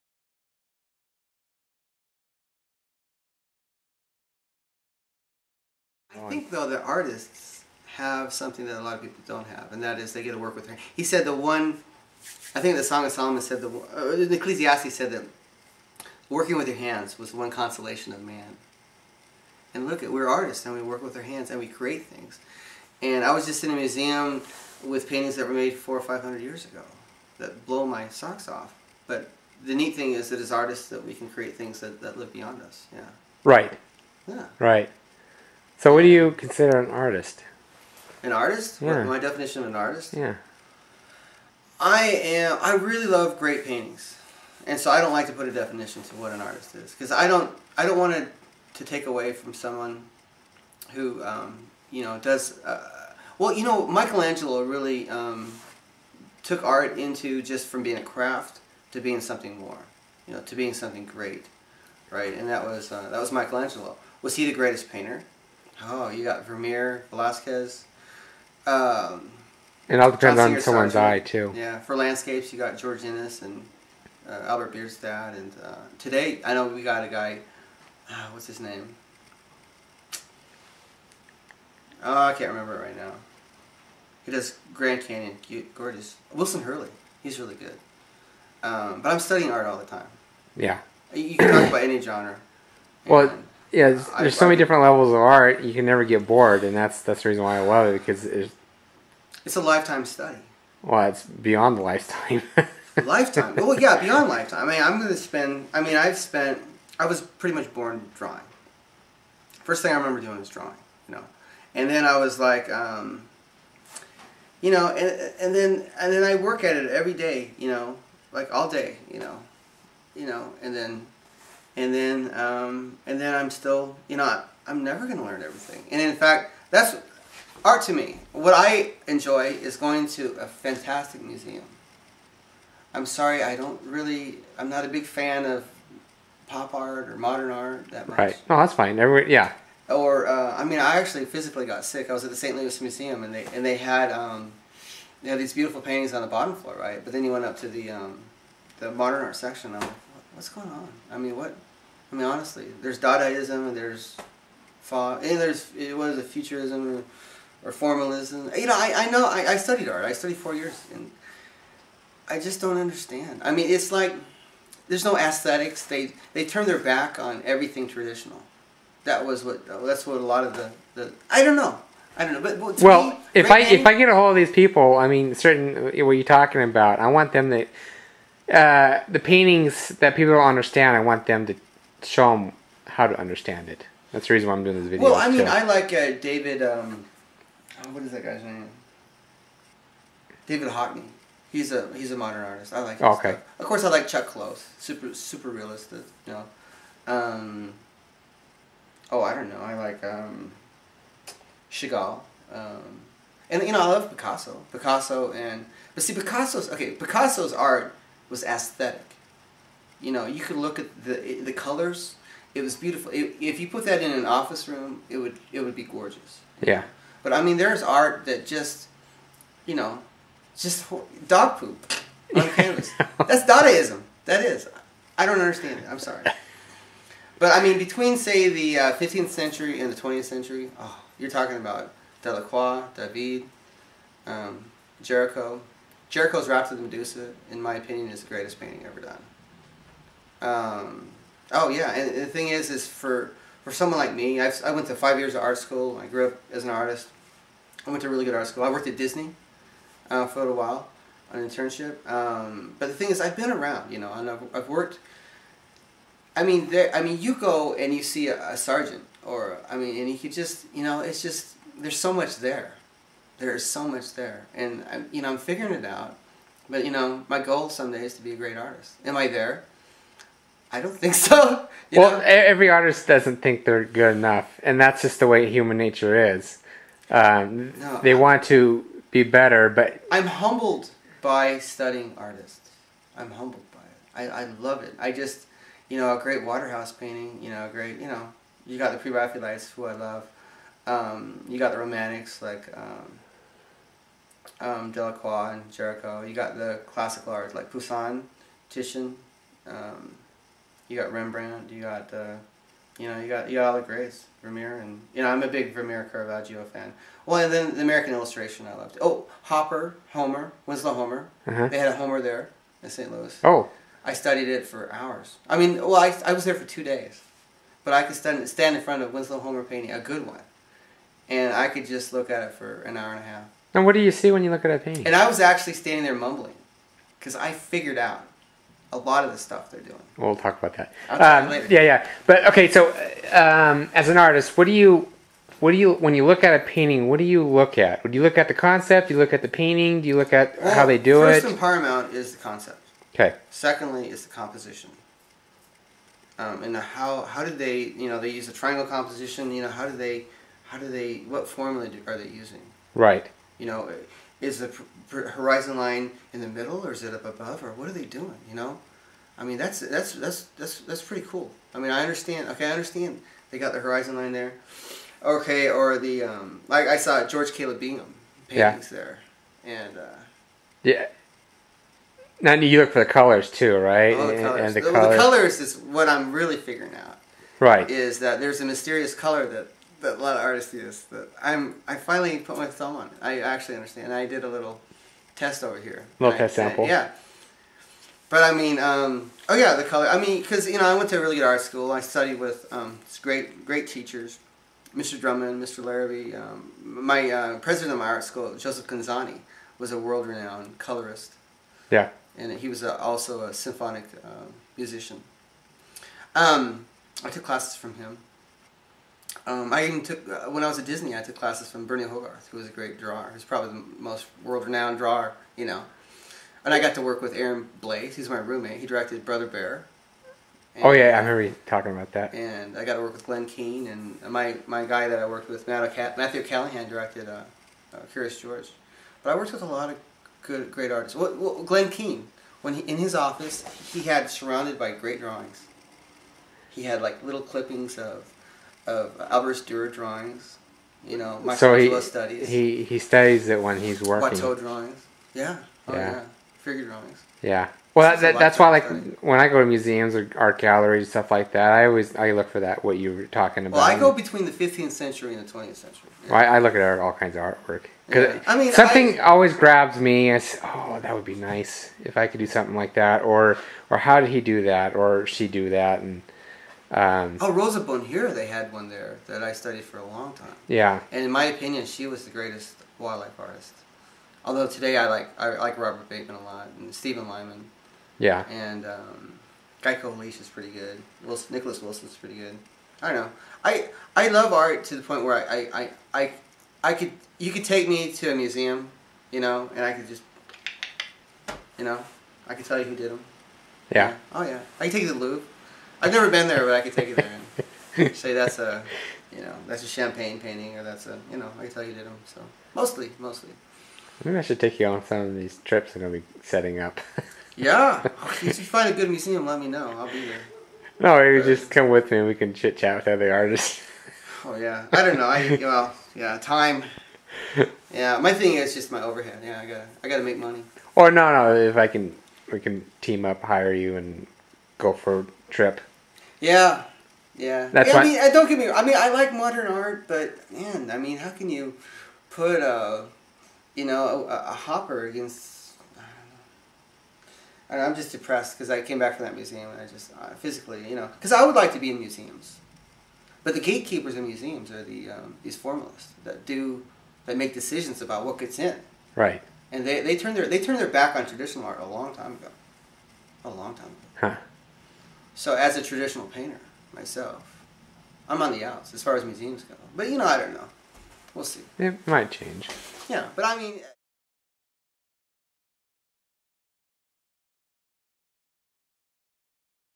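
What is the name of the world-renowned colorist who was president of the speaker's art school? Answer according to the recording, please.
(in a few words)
Joseph Gonzani.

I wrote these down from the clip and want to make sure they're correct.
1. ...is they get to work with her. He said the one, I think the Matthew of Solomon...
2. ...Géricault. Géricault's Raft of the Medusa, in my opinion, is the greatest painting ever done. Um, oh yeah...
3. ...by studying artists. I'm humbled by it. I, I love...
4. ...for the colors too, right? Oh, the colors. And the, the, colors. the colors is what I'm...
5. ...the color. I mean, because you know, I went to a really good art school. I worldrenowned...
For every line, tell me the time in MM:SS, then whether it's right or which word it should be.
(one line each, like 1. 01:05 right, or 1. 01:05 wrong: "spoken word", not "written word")
1. 00:09 wrong: "Song", not "Matthew"
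2. 03:55 right
3. 04:41 right
4. 06:12 right
5. 06:29 wrong: "studied", not "worldrenowned".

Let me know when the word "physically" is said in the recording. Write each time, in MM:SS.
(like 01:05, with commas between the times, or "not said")
02:21, 09:00.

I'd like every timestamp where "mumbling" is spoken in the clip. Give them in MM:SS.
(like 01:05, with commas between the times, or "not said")
05:26.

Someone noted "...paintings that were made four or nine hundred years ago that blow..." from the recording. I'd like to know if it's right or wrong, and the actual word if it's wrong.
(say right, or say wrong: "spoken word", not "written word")
wrong: "five", not "nine".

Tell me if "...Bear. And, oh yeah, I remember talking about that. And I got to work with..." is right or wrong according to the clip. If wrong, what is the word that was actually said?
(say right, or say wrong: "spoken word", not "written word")
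right.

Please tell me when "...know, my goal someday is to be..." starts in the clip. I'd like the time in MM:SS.
04:26.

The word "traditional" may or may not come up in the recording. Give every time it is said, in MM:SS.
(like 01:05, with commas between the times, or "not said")
02:47, 09:11, 09:15.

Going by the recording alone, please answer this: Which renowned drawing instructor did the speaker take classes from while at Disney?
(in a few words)
Burne Hogarth.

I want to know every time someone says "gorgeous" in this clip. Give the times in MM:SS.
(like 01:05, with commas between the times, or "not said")
01:25, 03:35.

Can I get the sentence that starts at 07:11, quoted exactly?
Well, well, Glen Keane, when he, in his office, he had surrounded by great drawings.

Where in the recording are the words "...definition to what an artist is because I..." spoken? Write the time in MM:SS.
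00:45.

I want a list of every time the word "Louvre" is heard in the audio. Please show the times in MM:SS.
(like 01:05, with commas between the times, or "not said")
08:15.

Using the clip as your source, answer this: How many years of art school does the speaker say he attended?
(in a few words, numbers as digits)
5.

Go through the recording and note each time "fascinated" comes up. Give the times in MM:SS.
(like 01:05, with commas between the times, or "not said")
not said.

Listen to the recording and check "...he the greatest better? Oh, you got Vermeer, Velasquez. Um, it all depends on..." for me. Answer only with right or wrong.
wrong.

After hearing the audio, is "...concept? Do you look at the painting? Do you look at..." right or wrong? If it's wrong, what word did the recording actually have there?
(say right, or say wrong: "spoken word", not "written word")
right.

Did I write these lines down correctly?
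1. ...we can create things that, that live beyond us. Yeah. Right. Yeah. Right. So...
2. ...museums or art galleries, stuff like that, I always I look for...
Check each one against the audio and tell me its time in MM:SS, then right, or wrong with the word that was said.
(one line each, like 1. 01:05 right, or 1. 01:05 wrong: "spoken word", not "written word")
1. 00:31 right
2. 07:29 right.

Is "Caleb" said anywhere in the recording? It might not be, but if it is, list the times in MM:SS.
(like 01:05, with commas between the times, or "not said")
06:07.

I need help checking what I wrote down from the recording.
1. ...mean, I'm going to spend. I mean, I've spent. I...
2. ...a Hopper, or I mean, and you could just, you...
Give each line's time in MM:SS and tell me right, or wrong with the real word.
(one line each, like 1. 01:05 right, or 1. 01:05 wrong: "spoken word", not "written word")
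1. 01:44 right
2. 04:18 wrong: "Sargent", not "Hopper".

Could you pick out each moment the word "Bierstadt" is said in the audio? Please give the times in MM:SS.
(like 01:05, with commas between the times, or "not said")
01:14.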